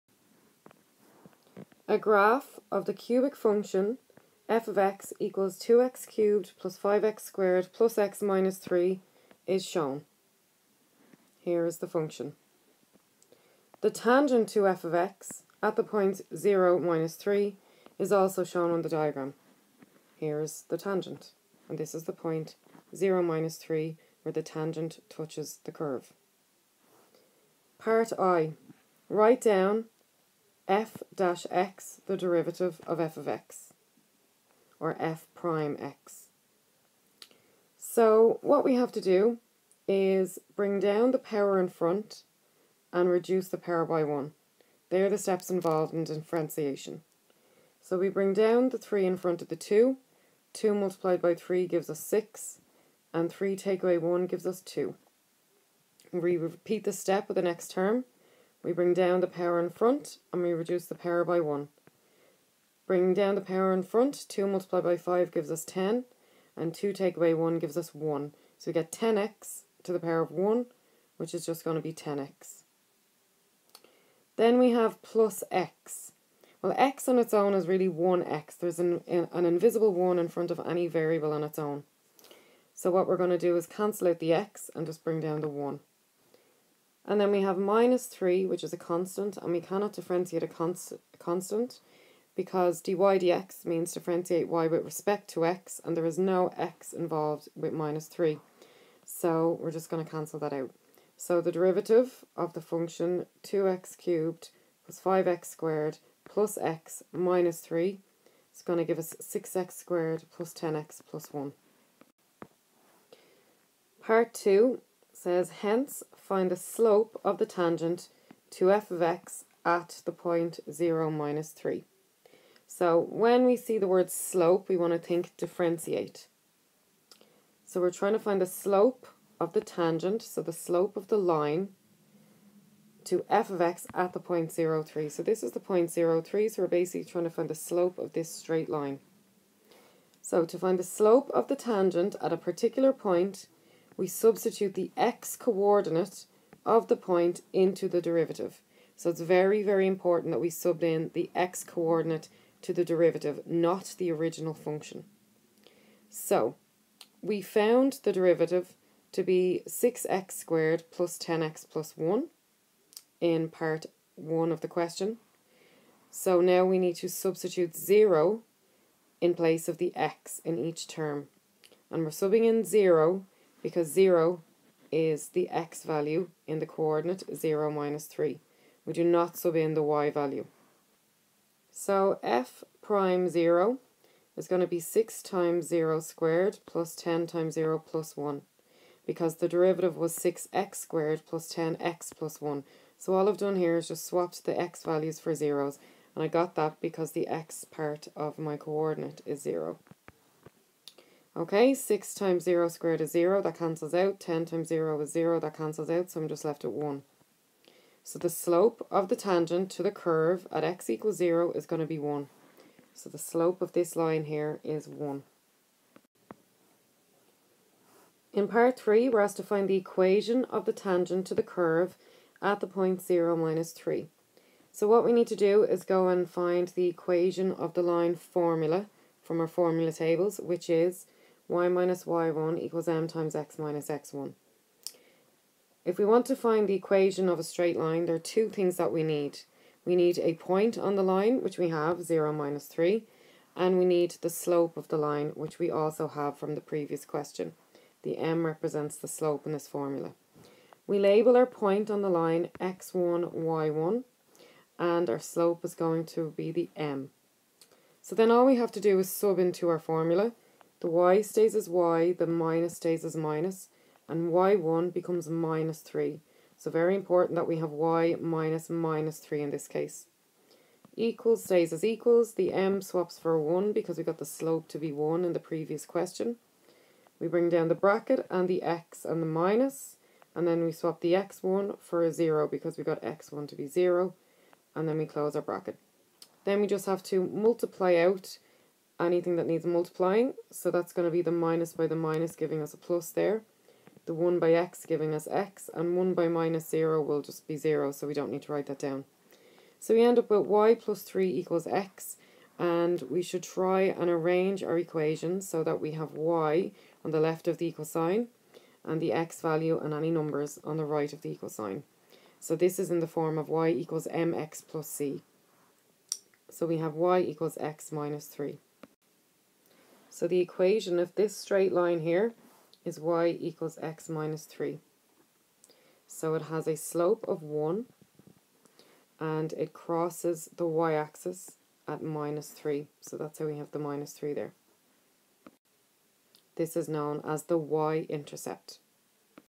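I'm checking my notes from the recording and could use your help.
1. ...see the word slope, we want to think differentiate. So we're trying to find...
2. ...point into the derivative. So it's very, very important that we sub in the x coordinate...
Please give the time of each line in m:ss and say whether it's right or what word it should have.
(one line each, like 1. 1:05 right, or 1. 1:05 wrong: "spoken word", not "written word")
1. 2:03 right
2. 2:26 right.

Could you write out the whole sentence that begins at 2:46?
So now we need to substitute 0 in place of the x in each term.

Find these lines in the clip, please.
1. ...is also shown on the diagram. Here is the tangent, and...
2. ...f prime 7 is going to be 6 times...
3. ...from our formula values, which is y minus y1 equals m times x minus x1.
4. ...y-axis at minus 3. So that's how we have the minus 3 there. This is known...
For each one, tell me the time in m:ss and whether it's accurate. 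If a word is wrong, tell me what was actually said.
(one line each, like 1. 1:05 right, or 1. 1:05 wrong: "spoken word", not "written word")
1. 0:17 right
2. 3:02 wrong: "0", not "7"
3. 3:49 wrong: "tables", not "values"
4. 5:30 right.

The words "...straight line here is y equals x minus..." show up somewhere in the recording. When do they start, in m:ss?
5:21.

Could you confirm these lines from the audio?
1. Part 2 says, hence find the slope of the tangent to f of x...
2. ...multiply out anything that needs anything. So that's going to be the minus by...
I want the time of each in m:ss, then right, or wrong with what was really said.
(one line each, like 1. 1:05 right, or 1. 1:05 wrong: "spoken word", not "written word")
1. 1:54 right
2. 4:47 wrong: "multiplying", not "anything".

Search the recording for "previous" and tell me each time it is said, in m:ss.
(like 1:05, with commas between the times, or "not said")
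4:06, 4:35.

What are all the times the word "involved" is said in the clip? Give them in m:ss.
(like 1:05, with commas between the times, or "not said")
0:45, 1:36.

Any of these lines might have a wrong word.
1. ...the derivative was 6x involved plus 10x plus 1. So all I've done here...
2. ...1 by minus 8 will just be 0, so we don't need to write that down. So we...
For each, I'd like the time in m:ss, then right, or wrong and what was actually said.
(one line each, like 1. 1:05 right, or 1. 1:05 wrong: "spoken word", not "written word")
1. 3:09 wrong: "squared", not "involved"
2. 4:55 wrong: "0", not "8".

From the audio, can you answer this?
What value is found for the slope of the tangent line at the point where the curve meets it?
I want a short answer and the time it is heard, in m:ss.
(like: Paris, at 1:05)
1, at 3:28.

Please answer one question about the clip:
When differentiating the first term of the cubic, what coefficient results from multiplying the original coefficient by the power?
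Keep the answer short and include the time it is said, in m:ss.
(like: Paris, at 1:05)
6, at 0:50.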